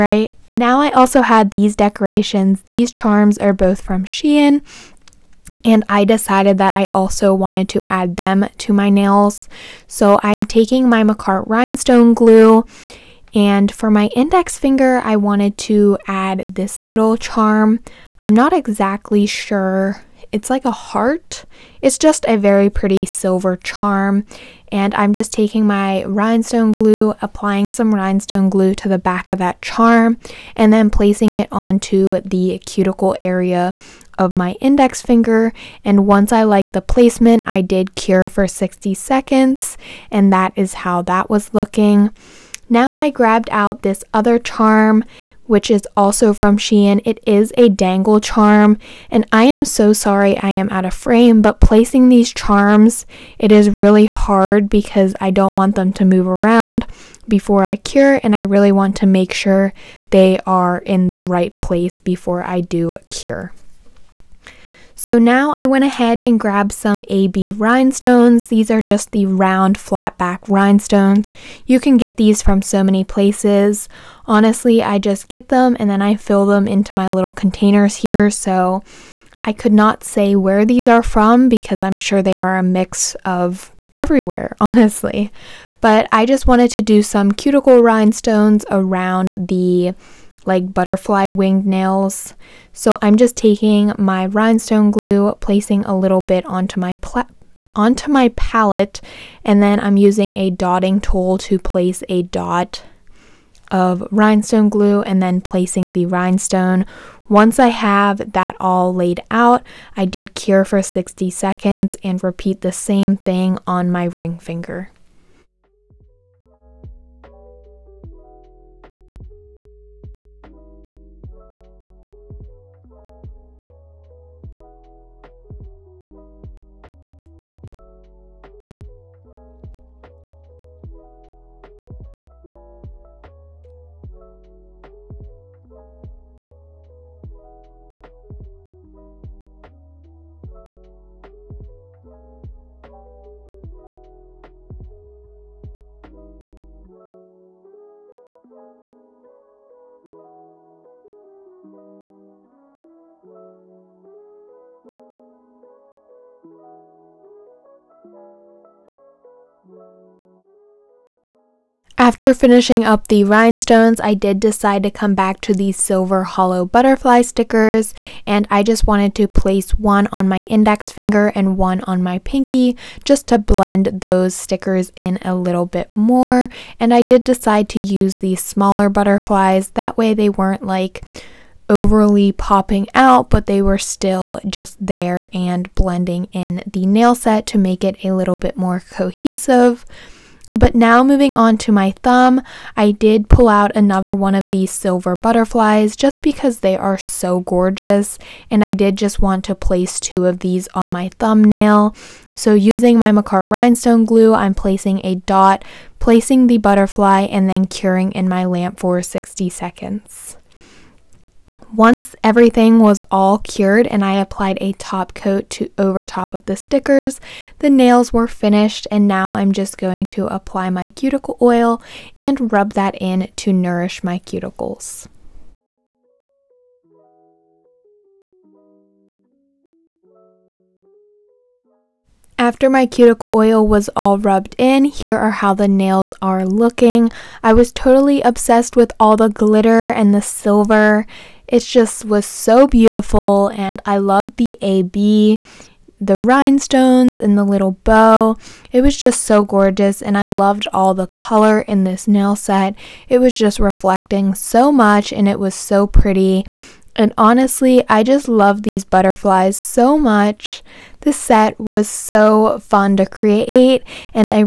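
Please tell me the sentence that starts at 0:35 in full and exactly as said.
And once I like the placement, I did cure for 60 seconds, and that is how that was looking.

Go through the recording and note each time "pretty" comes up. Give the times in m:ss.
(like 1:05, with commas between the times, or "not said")
0:22, 4:15.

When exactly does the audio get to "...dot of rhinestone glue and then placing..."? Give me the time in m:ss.
1:42.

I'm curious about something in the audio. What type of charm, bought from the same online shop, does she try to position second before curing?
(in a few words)
dangle charm.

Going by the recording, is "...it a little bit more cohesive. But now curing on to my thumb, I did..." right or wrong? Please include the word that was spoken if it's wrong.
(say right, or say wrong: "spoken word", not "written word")
wrong: "moving", not "curing".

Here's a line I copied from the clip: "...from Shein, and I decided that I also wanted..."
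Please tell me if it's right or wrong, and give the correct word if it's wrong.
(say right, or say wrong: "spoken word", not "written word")
right.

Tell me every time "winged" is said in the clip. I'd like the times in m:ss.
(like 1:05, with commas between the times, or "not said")
1:31.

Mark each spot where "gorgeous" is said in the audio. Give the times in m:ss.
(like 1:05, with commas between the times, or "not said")
3:17, 4:09.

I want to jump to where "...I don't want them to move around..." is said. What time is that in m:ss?
0:55.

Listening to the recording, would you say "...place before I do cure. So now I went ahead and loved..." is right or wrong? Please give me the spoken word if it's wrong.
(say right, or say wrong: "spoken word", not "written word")
wrong: "grabbed", not "loved".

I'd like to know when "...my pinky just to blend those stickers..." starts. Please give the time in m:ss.
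2:52.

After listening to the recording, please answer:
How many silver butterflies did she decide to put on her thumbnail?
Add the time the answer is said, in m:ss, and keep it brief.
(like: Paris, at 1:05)
2, at 3:19.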